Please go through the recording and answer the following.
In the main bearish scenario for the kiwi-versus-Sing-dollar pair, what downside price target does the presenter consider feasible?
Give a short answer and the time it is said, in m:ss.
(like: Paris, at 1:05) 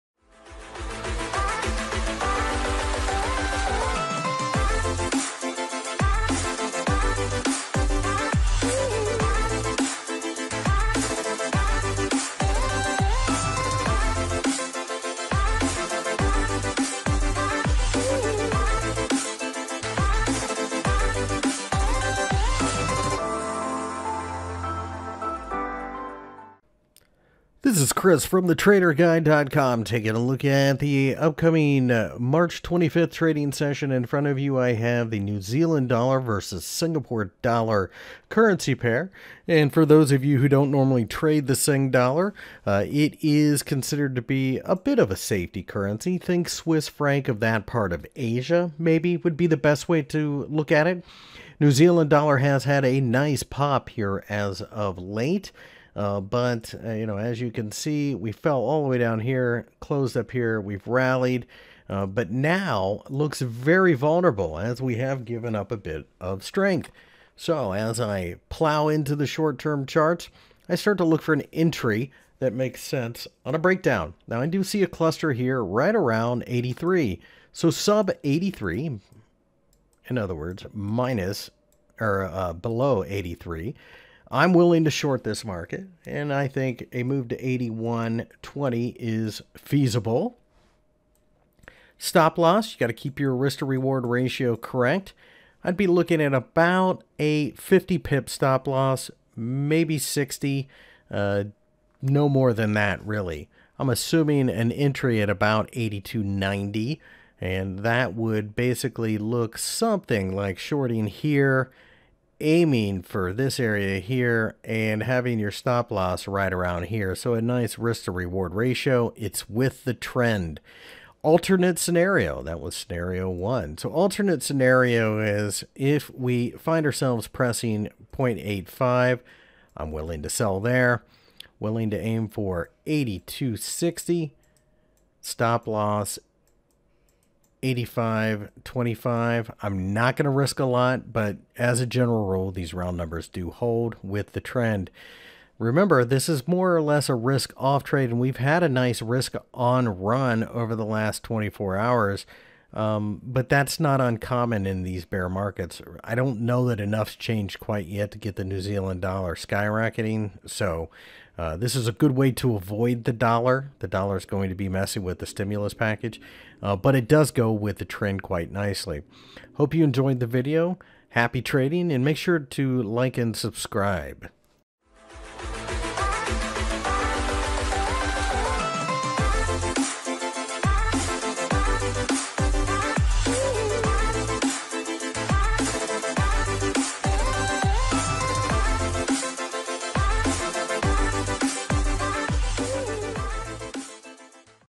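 81.20, at 1:27.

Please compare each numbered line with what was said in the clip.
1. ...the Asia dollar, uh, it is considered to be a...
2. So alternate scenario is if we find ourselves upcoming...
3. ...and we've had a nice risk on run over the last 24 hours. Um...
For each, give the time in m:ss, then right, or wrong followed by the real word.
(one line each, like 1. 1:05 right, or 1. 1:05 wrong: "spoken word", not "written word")
1. 0:41 wrong: "Sing", not "Asia"
2. 2:03 wrong: "pressing", not "upcoming"
3. 2:28 right.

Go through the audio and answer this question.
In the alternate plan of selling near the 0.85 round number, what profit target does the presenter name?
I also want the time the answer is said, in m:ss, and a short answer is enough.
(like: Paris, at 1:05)
82.60, at 2:12.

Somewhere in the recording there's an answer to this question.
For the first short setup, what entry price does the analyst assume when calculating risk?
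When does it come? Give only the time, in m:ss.
1:45.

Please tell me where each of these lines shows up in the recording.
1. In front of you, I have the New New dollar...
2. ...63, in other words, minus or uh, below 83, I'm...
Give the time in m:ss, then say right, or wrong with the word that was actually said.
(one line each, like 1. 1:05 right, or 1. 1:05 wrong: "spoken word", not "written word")
1. 0:33 wrong: "Zealand", not "New"
2. 1:18 wrong: "83", not "63".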